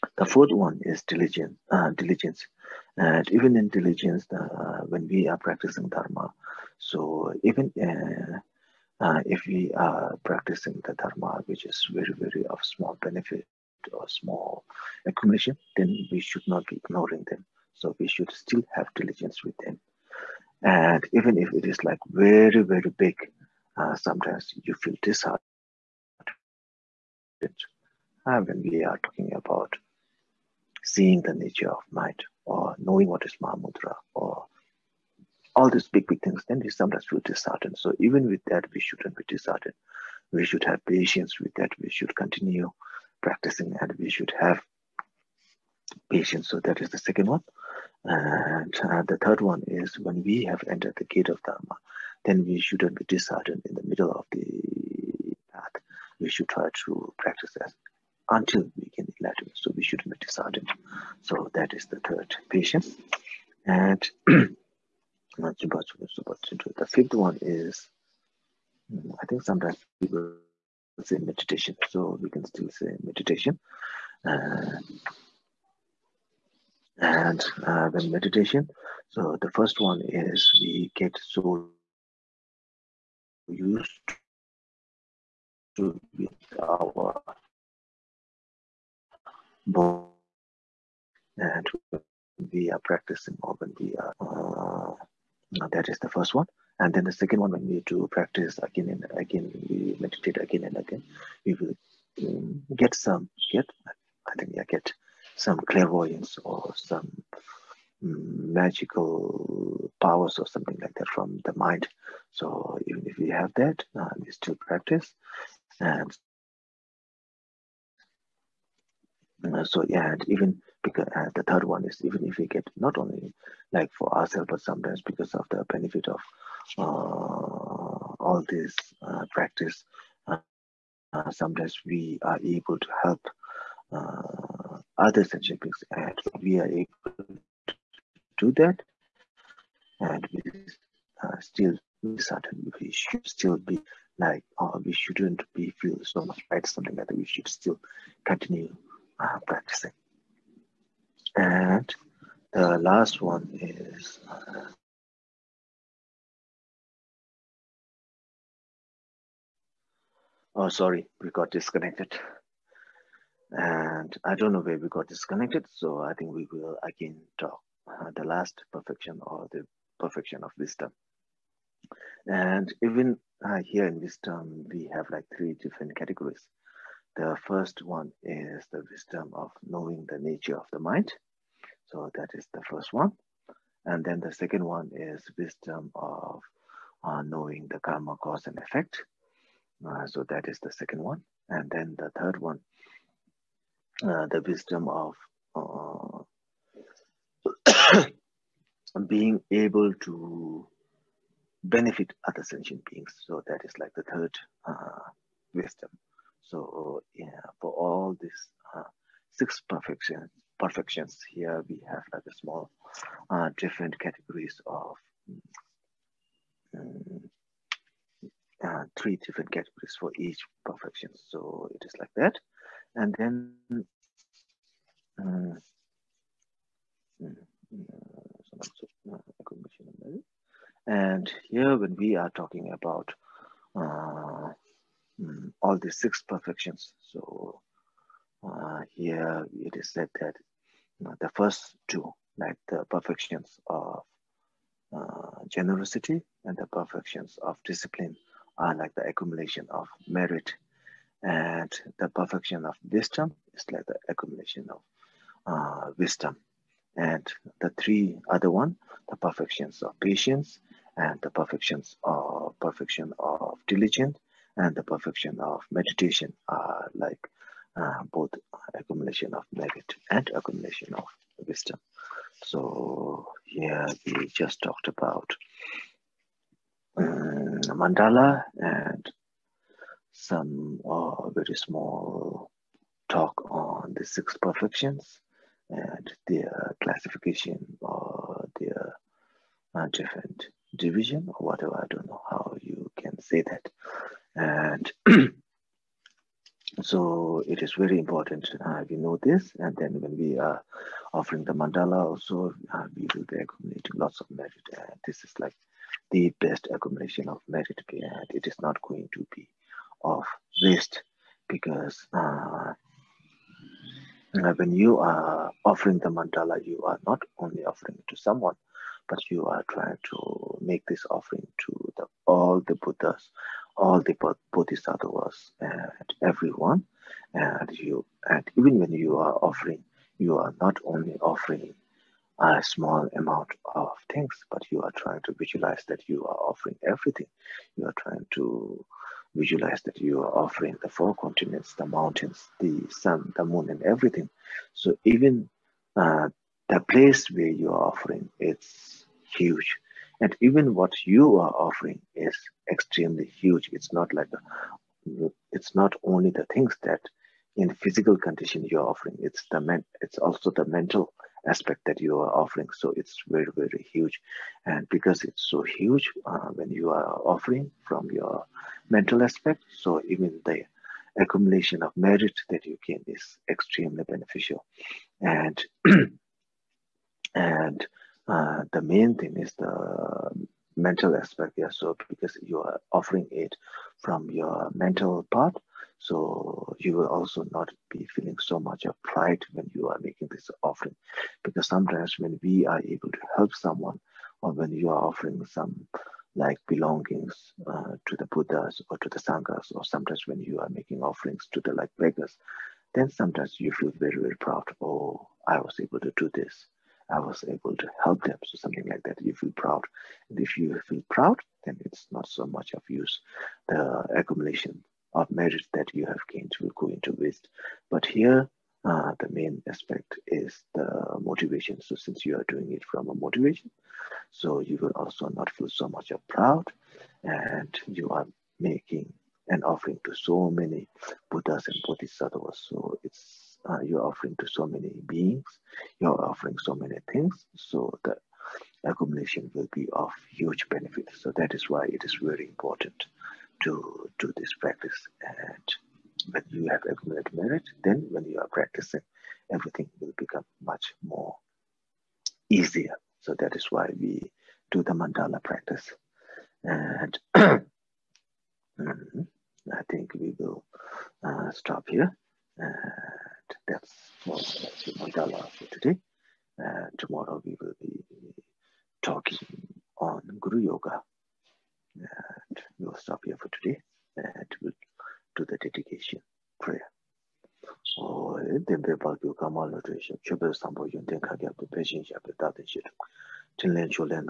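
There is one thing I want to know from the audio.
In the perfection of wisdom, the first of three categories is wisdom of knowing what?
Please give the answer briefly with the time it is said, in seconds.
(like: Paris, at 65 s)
the nature of the mind, at 180 s.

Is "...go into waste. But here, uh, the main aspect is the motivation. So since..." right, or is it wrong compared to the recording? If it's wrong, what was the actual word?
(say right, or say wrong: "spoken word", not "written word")
right.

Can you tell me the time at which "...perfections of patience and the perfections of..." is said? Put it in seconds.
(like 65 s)
259 s.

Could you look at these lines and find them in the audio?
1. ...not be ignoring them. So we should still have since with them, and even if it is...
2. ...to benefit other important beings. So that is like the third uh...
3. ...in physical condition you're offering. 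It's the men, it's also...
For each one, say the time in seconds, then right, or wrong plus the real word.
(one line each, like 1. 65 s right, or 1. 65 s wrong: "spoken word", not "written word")
1. 16 s wrong: "diligence", not "since"
2. 200 s wrong: "sentient", not "important"
3. 357 s right.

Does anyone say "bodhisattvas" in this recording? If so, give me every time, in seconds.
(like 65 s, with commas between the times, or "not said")
324 s, 431 s.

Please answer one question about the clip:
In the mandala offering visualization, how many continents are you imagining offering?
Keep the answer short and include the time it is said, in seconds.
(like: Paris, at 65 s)
4, at 340 s.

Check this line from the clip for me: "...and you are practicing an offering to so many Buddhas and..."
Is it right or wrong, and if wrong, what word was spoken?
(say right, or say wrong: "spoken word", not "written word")
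wrong: "making", not "practicing".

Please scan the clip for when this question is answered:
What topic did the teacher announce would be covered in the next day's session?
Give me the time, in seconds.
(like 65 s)
470 s.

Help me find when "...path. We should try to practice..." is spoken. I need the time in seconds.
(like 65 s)
55 s.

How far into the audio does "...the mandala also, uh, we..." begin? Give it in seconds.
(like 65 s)
301 s.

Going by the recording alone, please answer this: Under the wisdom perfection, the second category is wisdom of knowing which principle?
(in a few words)
karma cause and effect.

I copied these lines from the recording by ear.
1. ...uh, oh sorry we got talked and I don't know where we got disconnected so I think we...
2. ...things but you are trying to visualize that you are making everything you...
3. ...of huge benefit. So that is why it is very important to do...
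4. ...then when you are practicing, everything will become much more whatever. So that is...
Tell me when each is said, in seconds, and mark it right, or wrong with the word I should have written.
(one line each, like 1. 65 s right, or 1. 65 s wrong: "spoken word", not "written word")
1. 154 s wrong: "disconnected", not "talked"
2. 334 s wrong: "offering", not "making"
3. 439 s right
4. 447 s wrong: "easier", not "whatever".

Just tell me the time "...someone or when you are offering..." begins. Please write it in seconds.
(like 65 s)
393 s.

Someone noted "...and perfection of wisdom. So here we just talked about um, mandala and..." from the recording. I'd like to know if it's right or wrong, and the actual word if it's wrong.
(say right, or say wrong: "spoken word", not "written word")
wrong: "accumulation", not "perfection".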